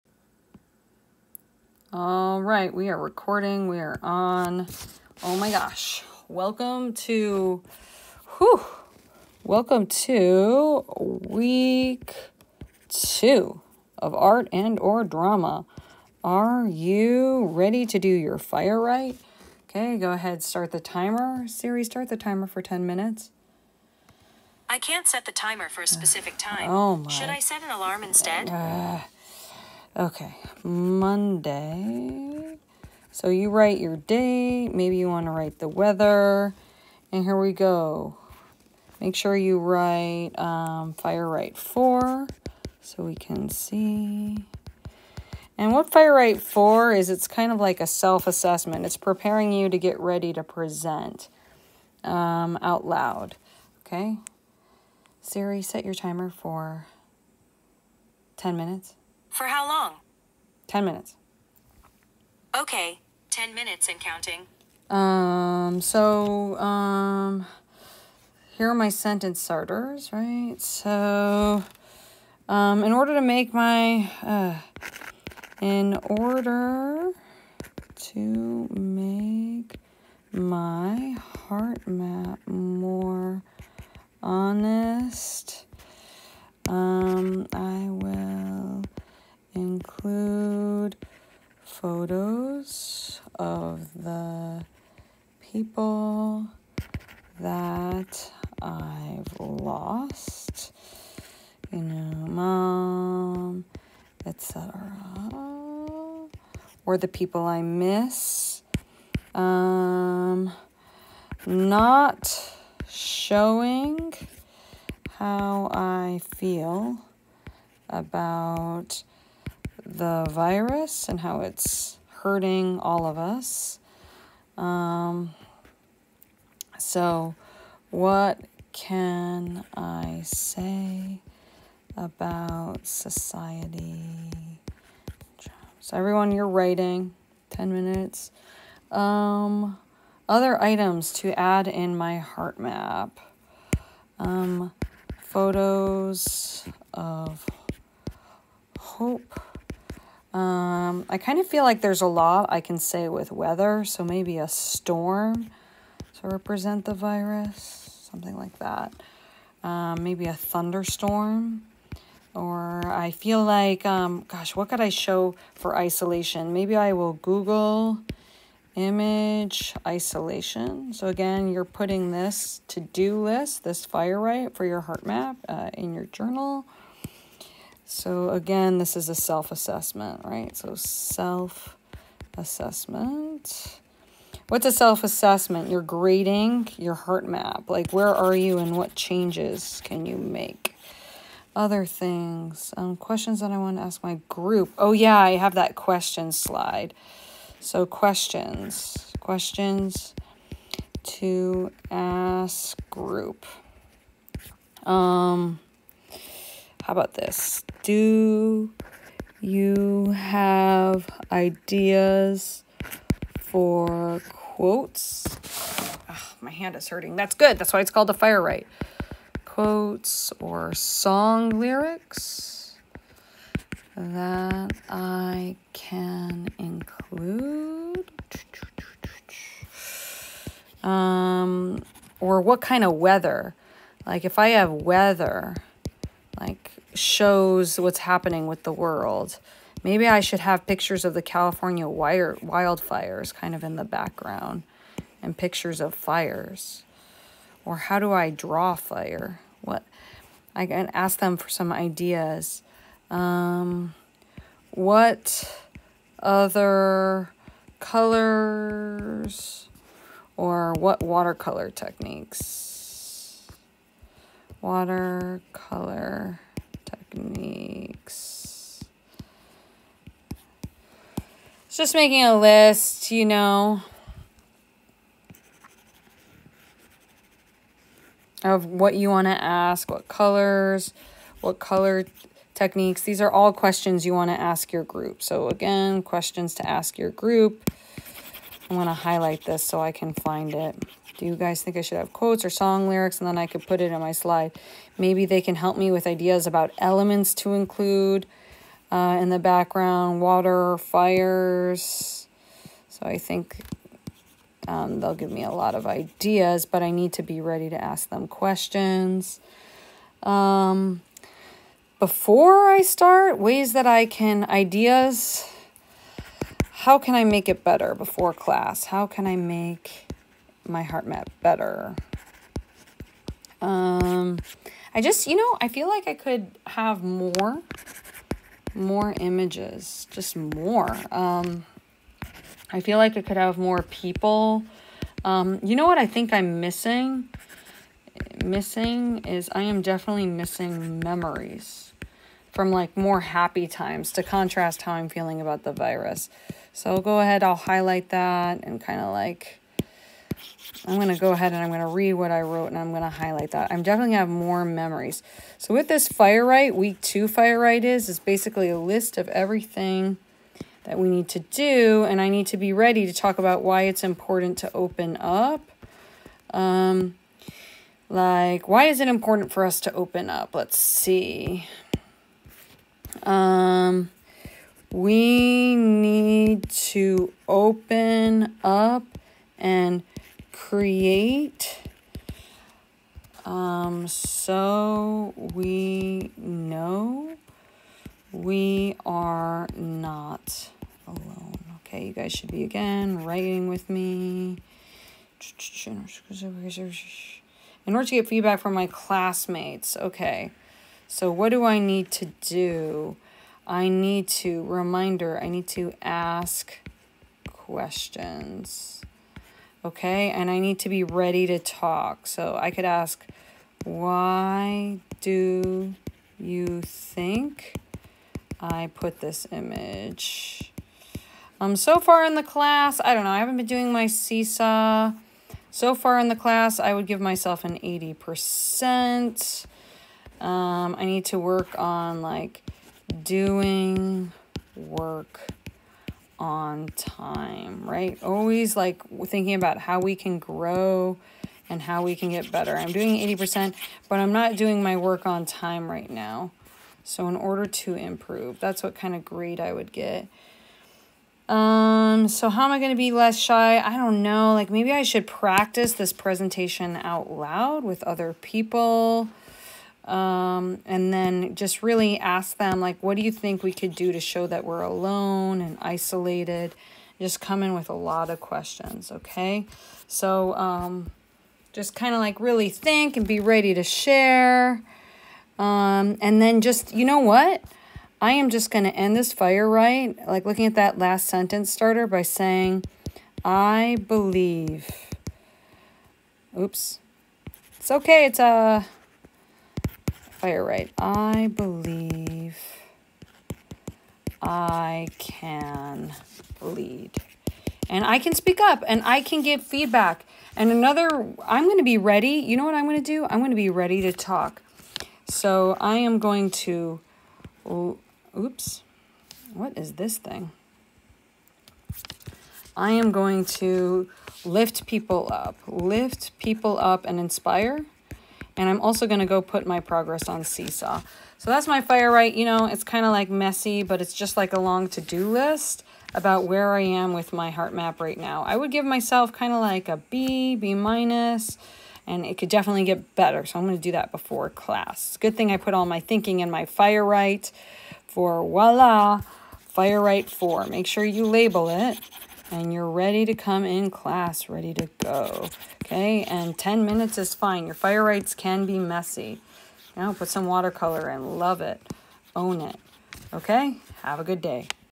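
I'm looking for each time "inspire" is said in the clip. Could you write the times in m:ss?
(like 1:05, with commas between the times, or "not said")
8:37.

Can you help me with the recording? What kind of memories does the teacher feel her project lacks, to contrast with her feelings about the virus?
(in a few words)
Happy times.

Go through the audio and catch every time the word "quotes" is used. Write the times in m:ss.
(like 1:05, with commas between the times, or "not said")
3:34, 3:39, 4:52.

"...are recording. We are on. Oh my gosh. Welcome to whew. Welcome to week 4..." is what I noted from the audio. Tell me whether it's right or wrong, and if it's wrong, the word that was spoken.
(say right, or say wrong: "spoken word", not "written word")
wrong: "2", not "4".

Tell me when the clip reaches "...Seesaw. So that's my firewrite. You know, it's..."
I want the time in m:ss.
8:40.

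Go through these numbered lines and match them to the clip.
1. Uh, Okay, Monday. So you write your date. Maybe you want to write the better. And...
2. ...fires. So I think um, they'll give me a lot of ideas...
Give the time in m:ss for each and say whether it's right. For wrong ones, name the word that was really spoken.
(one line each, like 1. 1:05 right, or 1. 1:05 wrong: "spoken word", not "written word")
1. 0:28 wrong: "weather", not "better"
2. 5:00 right.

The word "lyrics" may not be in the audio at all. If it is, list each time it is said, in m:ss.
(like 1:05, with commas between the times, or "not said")
3:41, 4:52.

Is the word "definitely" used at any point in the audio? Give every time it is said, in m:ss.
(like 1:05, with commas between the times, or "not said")
5:39, 5:53, 8:52.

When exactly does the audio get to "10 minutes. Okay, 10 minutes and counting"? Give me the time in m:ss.
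1:00.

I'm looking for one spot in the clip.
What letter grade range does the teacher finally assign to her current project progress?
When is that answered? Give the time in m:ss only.
8:49.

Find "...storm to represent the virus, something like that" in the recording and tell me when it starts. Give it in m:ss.
2:34.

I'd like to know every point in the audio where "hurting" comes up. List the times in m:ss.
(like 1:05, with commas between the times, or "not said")
2:02, 3:36.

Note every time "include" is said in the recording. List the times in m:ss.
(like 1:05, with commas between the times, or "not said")
1:30, 3:46, 4:57.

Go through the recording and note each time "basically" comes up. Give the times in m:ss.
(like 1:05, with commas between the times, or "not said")
5:58.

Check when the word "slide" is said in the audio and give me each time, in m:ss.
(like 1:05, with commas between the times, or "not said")
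3:16, 4:54.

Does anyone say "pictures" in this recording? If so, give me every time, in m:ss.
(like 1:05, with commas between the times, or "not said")
4:00, 4:05.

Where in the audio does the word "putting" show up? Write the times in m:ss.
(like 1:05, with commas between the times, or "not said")
2:51.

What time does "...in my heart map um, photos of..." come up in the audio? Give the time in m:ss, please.
2:21.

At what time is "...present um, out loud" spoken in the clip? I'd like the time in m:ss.
0:50.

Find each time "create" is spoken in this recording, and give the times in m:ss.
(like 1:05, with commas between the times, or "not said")
6:20.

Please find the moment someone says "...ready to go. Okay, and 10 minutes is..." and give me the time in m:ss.
9:04.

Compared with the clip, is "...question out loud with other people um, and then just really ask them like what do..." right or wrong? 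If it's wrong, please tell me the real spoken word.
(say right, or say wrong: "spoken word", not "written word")
wrong: "presentation", not "question".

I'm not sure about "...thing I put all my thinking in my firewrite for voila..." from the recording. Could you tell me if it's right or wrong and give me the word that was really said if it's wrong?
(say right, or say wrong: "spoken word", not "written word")
right.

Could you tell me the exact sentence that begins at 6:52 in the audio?
So I could ask, why do you think I put this image?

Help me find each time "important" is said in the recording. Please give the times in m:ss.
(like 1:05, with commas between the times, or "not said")
6:04, 6:09.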